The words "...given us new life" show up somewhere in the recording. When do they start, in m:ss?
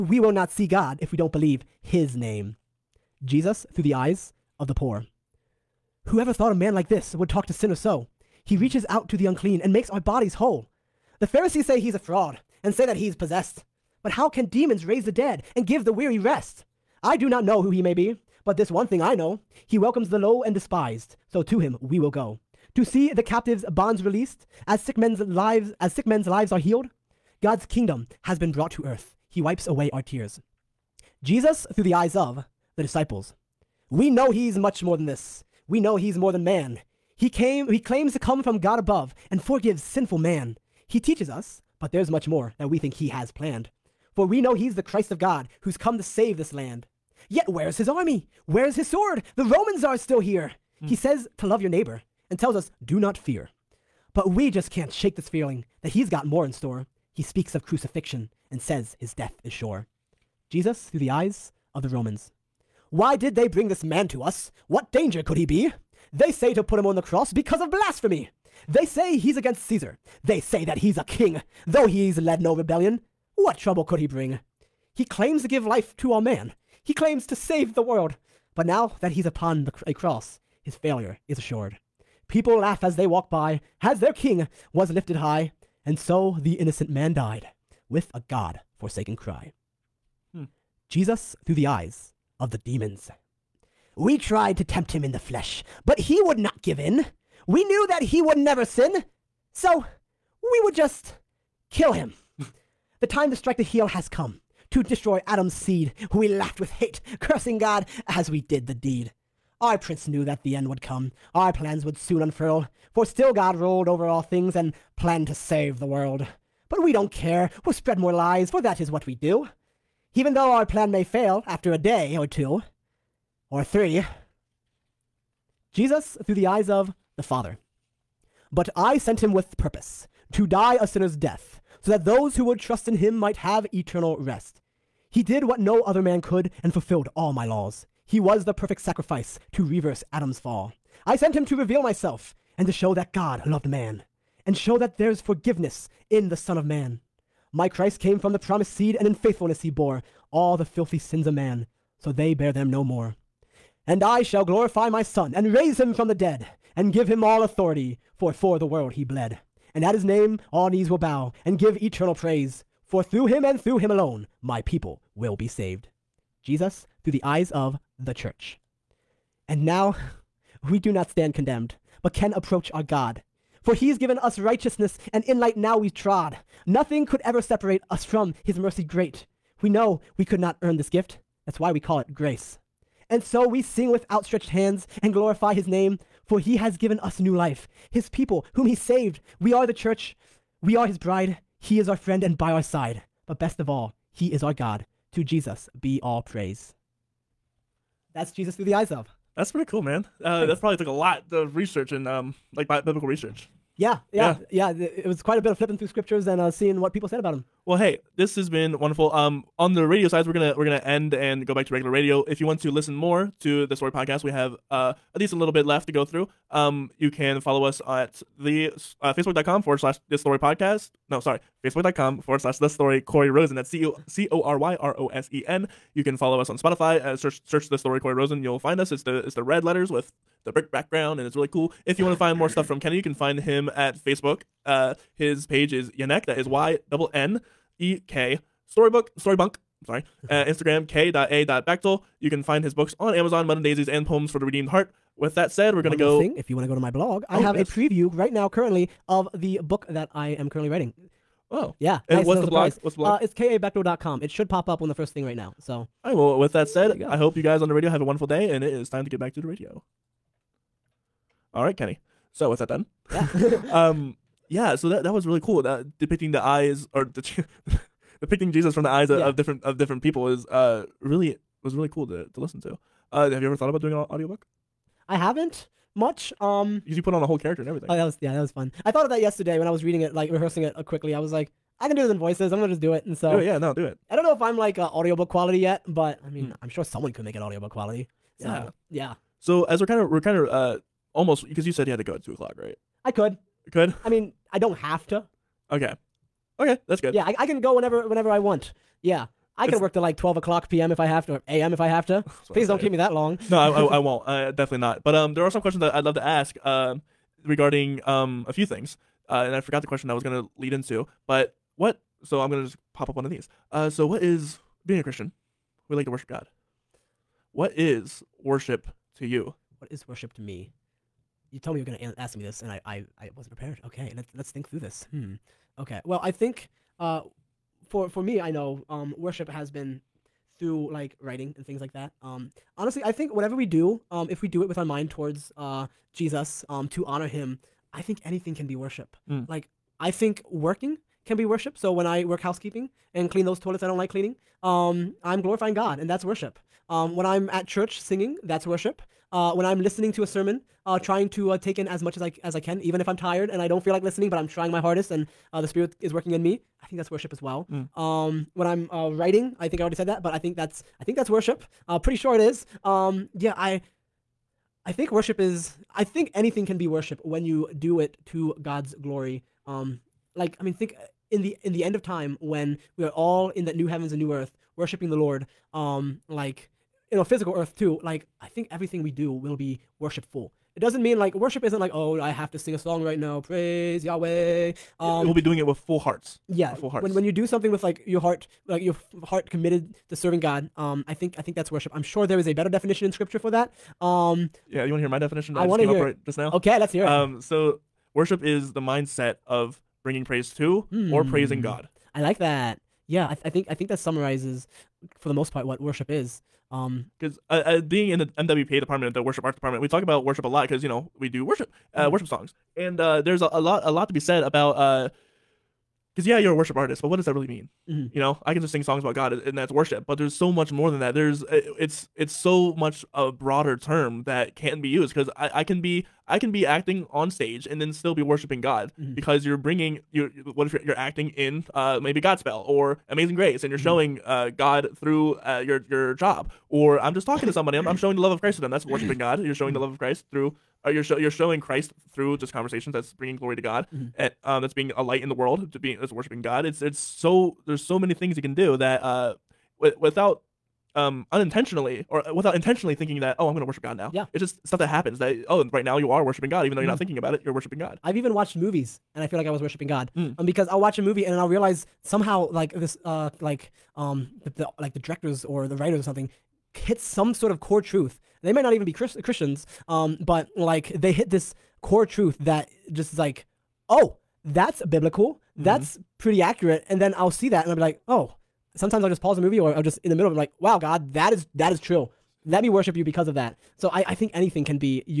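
3:06.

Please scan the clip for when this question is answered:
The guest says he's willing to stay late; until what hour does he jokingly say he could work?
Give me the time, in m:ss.
5:00.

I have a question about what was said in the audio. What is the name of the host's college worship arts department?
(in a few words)
MWPA.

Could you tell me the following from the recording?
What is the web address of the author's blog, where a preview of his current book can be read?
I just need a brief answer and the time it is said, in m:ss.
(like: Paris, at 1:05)
kabechtel.com, at 4:13.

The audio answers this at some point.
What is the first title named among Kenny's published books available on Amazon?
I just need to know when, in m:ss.
4:03.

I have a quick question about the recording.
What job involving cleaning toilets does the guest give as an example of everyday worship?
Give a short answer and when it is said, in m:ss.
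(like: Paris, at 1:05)
Housekeeping, at 5:42.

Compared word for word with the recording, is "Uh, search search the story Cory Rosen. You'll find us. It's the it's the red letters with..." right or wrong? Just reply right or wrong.
right.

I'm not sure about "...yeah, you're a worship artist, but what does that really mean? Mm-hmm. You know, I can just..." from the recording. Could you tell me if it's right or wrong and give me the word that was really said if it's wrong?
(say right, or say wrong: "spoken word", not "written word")
right.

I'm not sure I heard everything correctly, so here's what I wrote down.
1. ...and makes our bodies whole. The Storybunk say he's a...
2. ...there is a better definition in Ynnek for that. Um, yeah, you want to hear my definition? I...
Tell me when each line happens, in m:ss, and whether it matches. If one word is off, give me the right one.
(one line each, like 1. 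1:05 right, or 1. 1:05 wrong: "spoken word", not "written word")
1. 0:09 wrong: "Pharisees", not "Storybunk"
2. 6:32 wrong: "Scripture", not "Ynnek".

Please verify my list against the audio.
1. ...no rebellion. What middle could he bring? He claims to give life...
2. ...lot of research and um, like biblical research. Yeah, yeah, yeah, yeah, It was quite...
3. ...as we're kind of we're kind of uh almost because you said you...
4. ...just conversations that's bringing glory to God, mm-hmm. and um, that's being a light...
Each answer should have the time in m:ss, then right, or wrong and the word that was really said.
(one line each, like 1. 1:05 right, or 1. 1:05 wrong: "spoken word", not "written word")
1. 1:12 wrong: "trouble", not "middle"
2. 3:20 right
3. 4:49 right
4. 7:22 right.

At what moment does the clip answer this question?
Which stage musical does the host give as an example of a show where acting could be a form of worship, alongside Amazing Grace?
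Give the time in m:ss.
7:12.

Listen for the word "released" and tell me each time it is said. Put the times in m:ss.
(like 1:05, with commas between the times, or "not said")
0:24.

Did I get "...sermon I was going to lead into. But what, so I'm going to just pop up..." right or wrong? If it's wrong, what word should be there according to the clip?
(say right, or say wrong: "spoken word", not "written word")
wrong: "question", not "sermon".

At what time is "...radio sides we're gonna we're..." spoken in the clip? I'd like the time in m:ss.
3:29.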